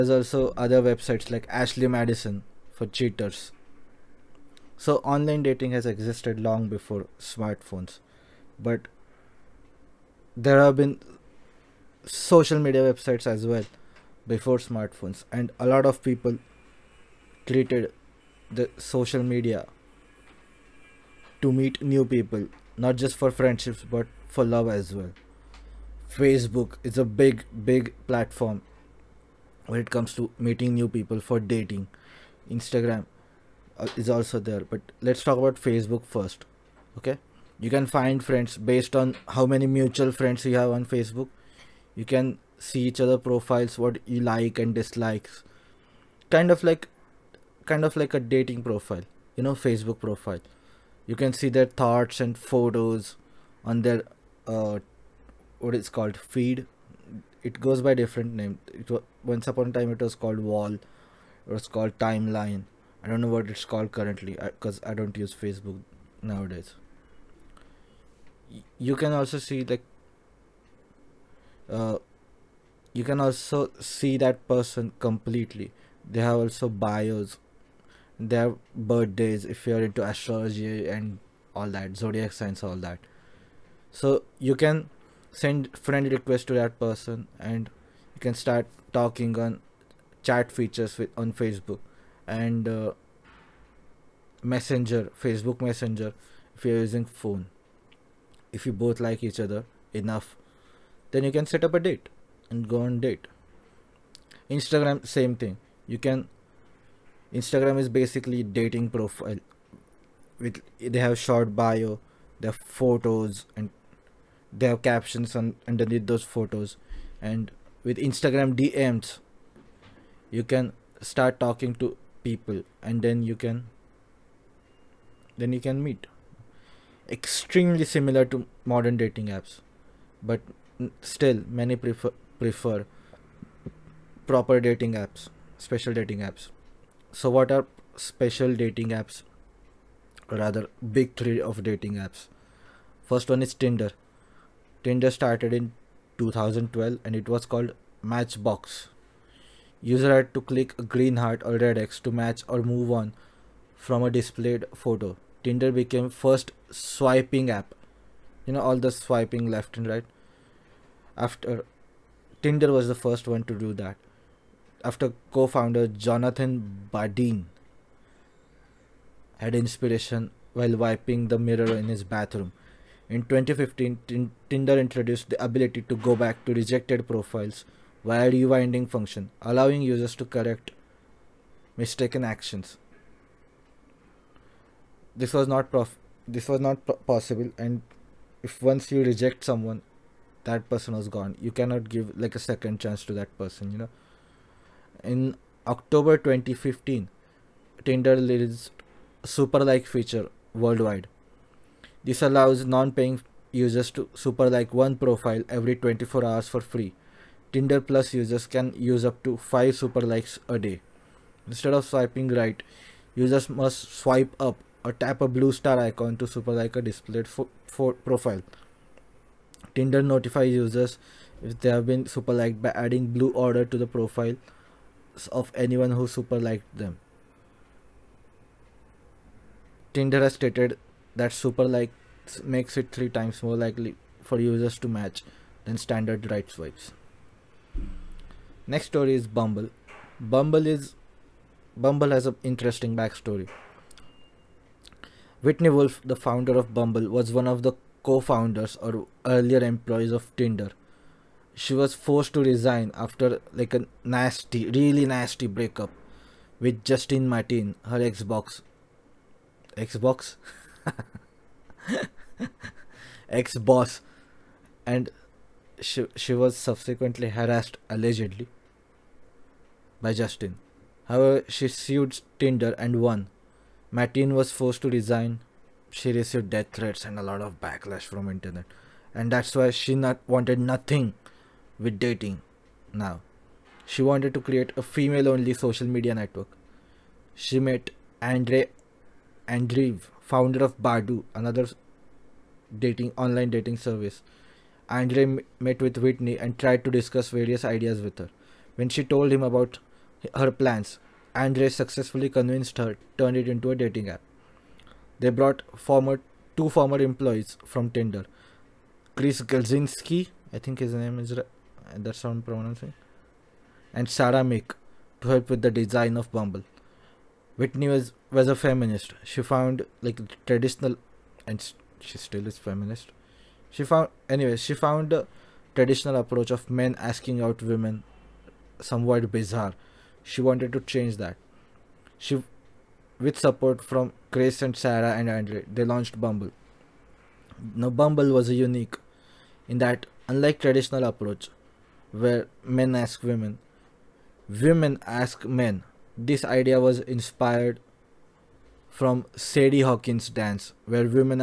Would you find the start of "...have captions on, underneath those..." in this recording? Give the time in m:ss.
1:54.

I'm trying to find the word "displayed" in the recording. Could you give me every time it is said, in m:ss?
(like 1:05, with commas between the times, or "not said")
2:34, 3:36.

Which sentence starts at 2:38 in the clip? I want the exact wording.
You know all the swiping left and right.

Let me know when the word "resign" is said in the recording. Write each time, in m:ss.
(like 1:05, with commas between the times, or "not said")
4:12, 4:34.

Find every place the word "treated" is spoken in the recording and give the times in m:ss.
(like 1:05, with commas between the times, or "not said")
0:17.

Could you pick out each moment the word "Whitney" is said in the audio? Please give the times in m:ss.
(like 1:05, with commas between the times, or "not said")
4:05, 4:55, 5:17.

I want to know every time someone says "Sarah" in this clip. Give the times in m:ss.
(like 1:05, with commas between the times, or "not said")
5:14, 5:34.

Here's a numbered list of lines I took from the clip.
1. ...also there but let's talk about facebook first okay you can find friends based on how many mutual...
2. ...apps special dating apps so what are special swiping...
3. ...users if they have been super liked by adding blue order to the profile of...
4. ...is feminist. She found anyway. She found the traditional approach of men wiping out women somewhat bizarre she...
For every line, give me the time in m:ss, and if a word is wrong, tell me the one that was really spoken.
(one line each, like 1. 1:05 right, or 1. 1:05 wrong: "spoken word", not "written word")
1. 0:34 right
2. 2:14 wrong: "dating", not "swiping"
3. 3:40 right
4. 5:22 wrong: "asking", not "wiping".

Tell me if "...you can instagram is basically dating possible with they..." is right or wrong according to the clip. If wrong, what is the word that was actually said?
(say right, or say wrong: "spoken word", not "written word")
wrong: "profile", not "possible".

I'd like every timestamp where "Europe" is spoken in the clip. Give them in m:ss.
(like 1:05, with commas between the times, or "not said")
not said.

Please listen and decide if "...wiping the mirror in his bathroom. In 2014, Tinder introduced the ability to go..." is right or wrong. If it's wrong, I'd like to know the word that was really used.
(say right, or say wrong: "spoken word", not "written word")
wrong: "2015", not "2014".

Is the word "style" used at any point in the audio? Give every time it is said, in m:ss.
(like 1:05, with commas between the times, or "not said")
not said.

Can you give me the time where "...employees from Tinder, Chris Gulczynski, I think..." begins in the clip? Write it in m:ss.
5:07.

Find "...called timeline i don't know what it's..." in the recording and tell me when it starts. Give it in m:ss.
1:01.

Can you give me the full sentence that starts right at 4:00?
Bumble is Bumble has an interesting backstory.